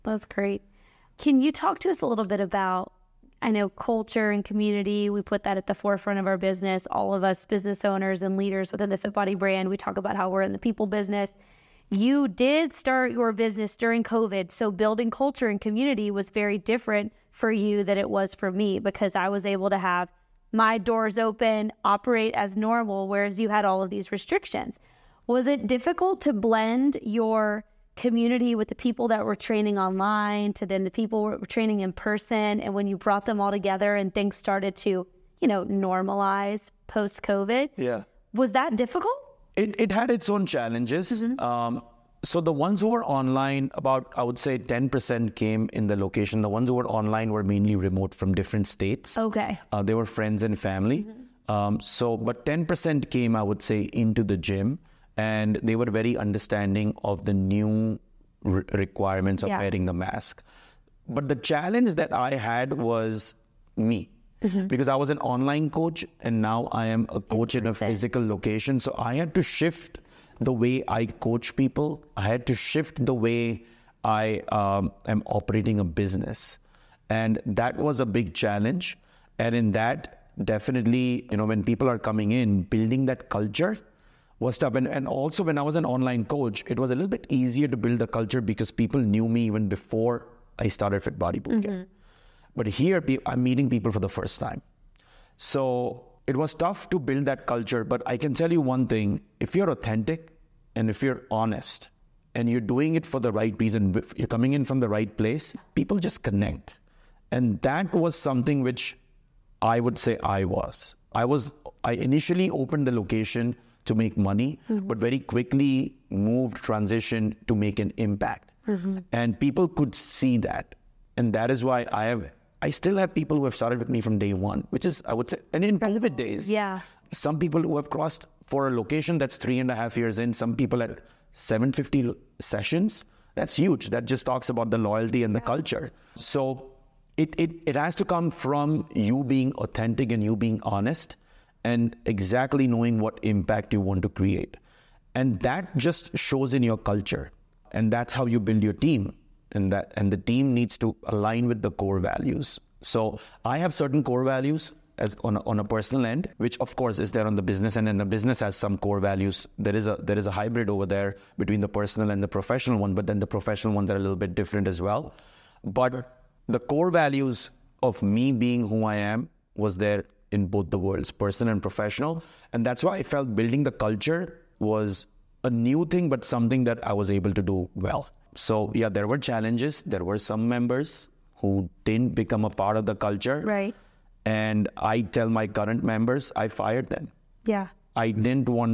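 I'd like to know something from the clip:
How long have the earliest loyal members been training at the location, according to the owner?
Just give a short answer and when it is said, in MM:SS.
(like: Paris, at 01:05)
3.5 years, at 02:09.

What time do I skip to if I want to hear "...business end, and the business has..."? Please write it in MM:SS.
02:37.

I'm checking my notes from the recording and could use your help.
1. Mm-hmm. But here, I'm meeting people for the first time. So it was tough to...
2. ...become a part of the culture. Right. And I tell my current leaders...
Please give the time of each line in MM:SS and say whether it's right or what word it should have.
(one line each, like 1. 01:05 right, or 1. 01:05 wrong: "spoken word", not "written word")
1. 01:31 right
2. 03:02 wrong: "members", not "leaders".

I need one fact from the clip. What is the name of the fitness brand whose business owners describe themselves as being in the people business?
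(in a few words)
FitBody.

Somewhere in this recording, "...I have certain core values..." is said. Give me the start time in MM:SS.
02:33.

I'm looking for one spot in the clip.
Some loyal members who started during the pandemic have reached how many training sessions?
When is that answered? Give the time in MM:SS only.
02:11.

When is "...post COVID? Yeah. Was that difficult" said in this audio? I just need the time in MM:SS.
00:36.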